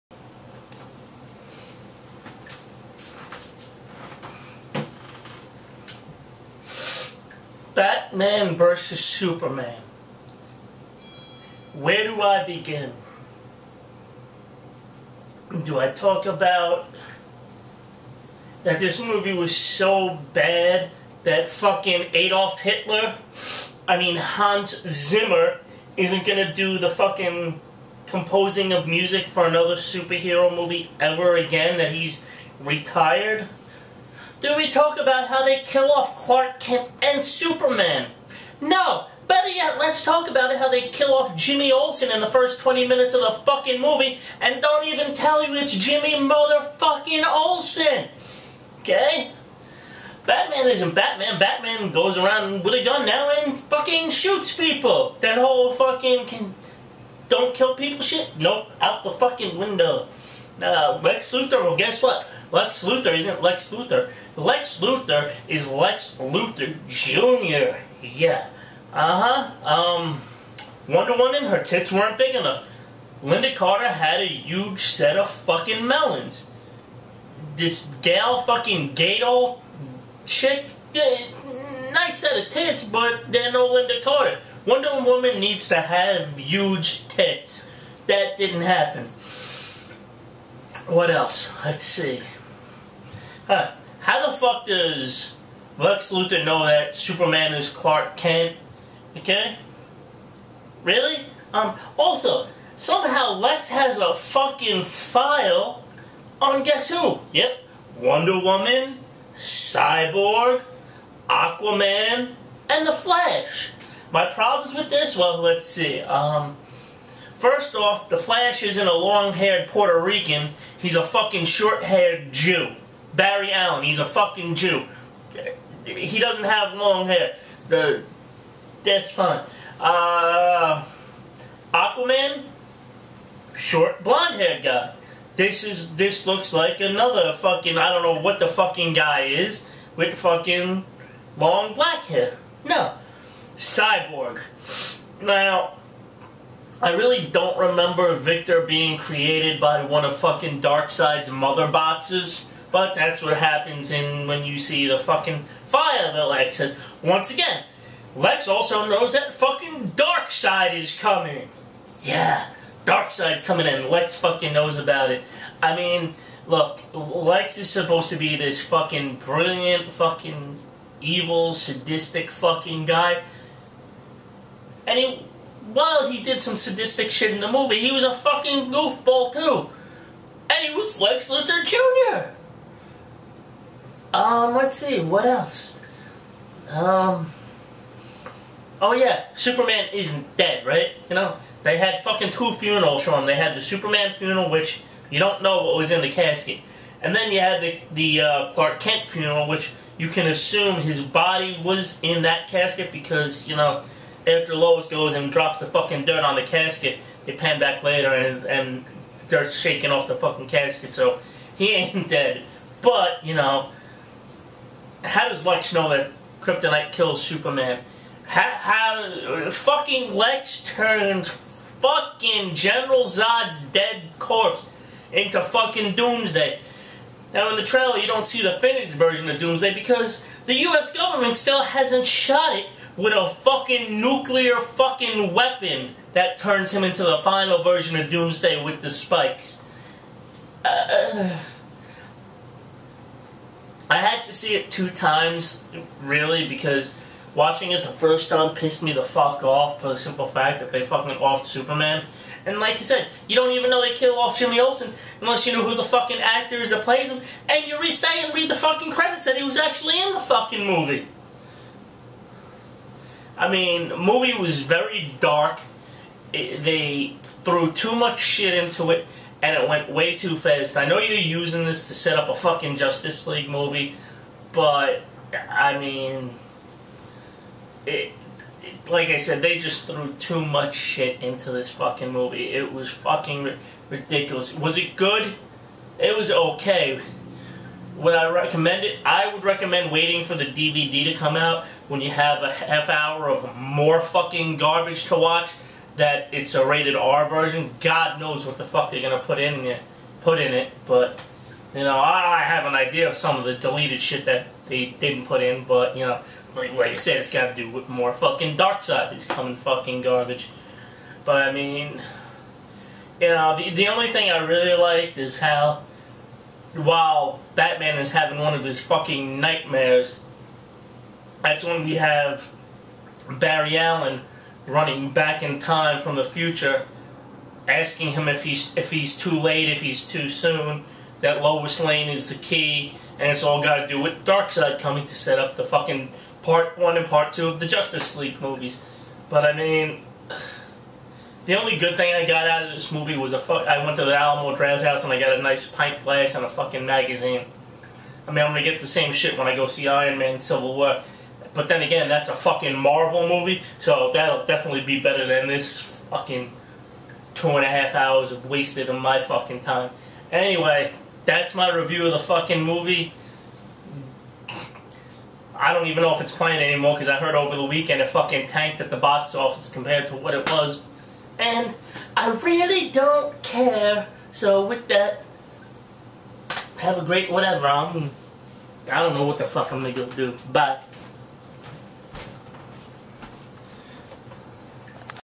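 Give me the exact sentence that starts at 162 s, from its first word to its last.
Yeah, Darkseid's coming and Lex fucking knows about it.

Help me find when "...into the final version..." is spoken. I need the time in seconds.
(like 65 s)
236 s.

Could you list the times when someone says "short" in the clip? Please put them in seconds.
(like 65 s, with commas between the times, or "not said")
121 s, 133 s.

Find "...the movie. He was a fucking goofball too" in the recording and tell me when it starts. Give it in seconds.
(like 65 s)
177 s.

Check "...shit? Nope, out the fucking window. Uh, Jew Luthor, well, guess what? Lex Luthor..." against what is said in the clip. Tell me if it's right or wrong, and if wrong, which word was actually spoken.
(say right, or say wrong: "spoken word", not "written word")
wrong: "Lex", not "Jew".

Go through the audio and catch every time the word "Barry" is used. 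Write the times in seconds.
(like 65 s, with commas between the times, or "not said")
123 s, 323 s.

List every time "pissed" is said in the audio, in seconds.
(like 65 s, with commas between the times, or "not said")
248 s.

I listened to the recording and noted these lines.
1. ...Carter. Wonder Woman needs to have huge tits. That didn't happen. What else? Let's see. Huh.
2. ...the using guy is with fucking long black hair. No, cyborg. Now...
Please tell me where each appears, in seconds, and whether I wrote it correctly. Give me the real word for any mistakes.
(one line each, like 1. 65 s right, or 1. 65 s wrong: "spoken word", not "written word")
1. 84 s right
2. 138 s wrong: "fucking", not "using".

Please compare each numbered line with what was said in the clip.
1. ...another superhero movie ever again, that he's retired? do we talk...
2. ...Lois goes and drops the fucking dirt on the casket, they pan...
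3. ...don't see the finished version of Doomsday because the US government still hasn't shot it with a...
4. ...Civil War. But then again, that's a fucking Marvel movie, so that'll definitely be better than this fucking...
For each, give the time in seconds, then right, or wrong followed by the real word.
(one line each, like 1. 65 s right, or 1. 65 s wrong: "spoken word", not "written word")
1. 29 s right
2. 204 s right
3. 228 s right
4. 350 s right.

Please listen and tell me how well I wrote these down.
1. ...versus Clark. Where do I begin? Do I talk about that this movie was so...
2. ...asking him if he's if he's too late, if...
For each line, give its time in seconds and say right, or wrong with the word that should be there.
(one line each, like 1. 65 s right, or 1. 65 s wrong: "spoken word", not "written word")
1. 8 s wrong: "Superman", not "Clark"
2. 327 s right.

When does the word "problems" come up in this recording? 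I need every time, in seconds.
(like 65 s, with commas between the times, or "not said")
114 s.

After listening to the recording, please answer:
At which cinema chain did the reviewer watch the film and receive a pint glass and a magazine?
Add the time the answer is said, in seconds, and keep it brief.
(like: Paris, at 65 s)
Alamo Drafthouse, at 344 s.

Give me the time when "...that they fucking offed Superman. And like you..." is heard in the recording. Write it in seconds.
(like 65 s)
250 s.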